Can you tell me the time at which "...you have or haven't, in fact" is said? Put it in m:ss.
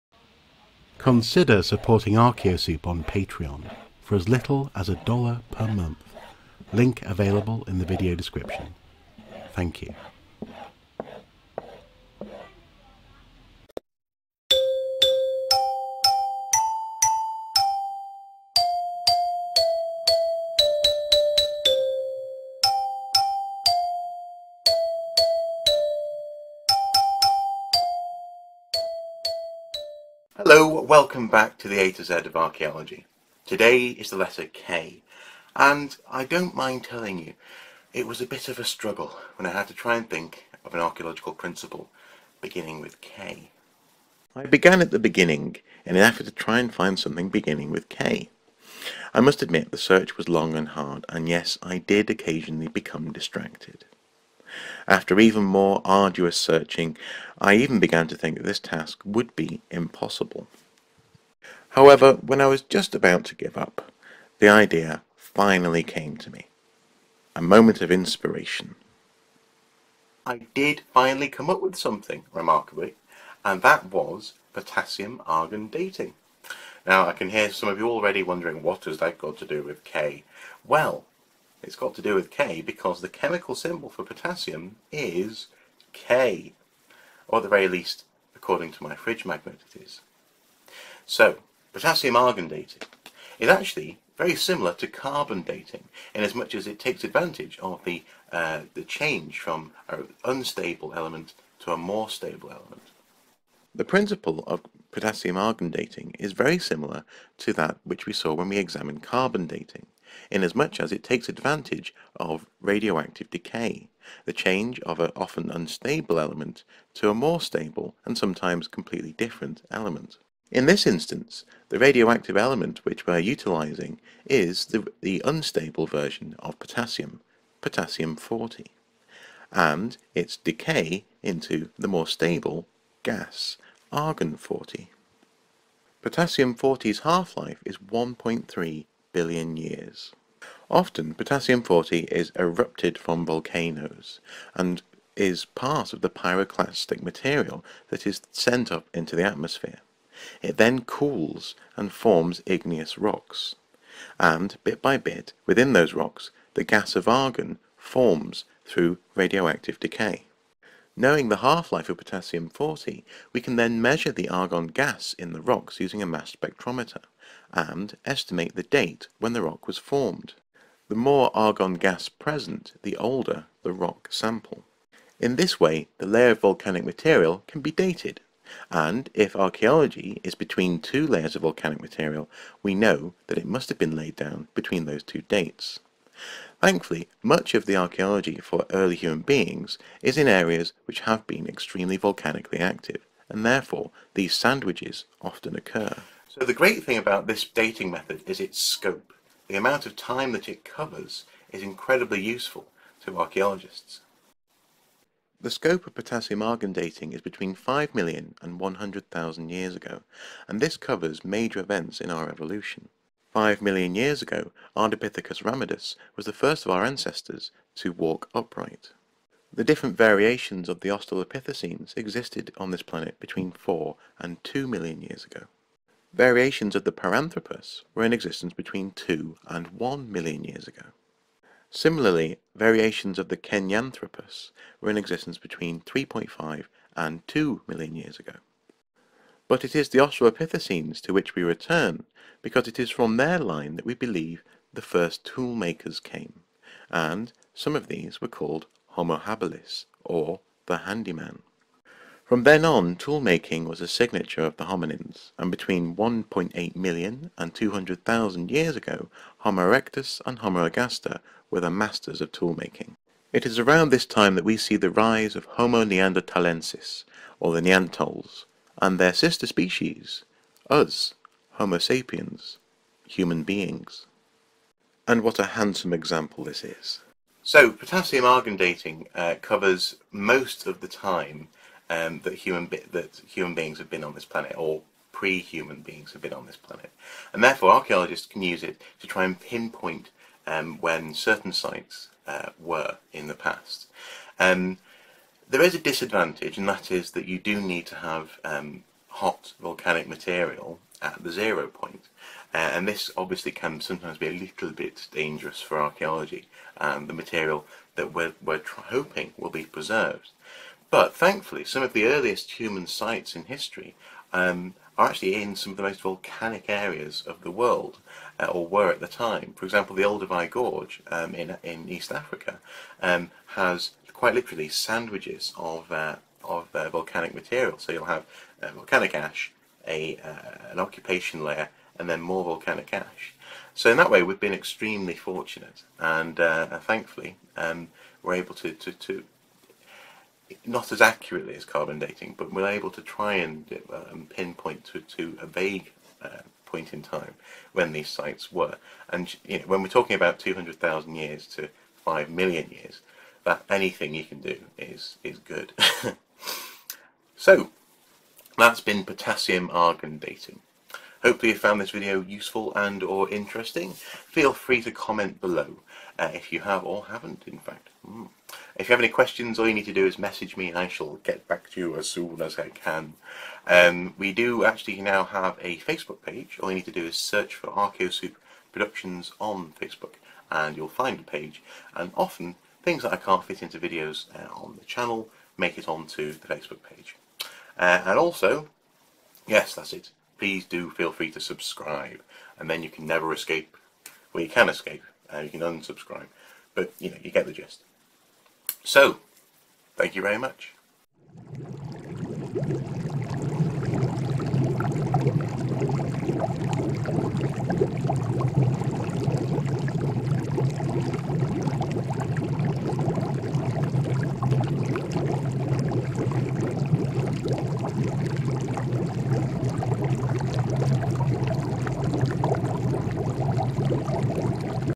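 6:06.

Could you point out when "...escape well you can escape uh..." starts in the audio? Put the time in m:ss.
6:33.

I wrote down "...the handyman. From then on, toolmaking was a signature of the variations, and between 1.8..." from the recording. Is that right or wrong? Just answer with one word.
wrong.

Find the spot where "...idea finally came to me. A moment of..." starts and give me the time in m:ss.
1:04.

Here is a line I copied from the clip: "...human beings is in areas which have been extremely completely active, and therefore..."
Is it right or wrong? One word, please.
wrong.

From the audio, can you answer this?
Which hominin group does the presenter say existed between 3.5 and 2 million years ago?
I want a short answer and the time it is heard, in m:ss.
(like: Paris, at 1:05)
Kenyanthropus, at 3:53.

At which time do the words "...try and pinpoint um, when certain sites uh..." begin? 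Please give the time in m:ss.
4:49.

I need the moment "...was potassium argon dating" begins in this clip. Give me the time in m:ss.
1:13.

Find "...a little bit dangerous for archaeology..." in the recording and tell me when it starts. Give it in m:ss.
5:04.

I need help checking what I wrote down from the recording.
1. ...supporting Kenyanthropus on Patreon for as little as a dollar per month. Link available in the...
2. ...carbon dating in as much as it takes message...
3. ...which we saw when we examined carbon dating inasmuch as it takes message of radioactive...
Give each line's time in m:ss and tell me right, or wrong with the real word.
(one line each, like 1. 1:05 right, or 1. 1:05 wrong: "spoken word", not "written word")
1. 0:01 wrong: "Archaeosoup", not "Kenyanthropus"
2. 1:34 wrong: "advantage", not "message"
3. 1:47 wrong: "advantage", not "message".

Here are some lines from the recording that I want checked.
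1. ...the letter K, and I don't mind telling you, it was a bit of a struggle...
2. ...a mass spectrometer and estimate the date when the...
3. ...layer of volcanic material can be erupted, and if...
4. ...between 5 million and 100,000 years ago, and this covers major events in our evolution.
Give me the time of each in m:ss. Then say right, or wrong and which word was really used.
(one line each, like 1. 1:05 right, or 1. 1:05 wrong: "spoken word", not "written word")
1. 0:34 right
2. 2:46 right
3. 2:56 wrong: "dated", not "erupted"
4. 3:27 right.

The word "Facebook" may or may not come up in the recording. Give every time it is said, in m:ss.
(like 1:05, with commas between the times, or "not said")
6:15, 6:19, 6:26.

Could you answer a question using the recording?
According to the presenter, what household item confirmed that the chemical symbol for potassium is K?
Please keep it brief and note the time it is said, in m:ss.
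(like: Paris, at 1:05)
Fridge magnet, at 1:28.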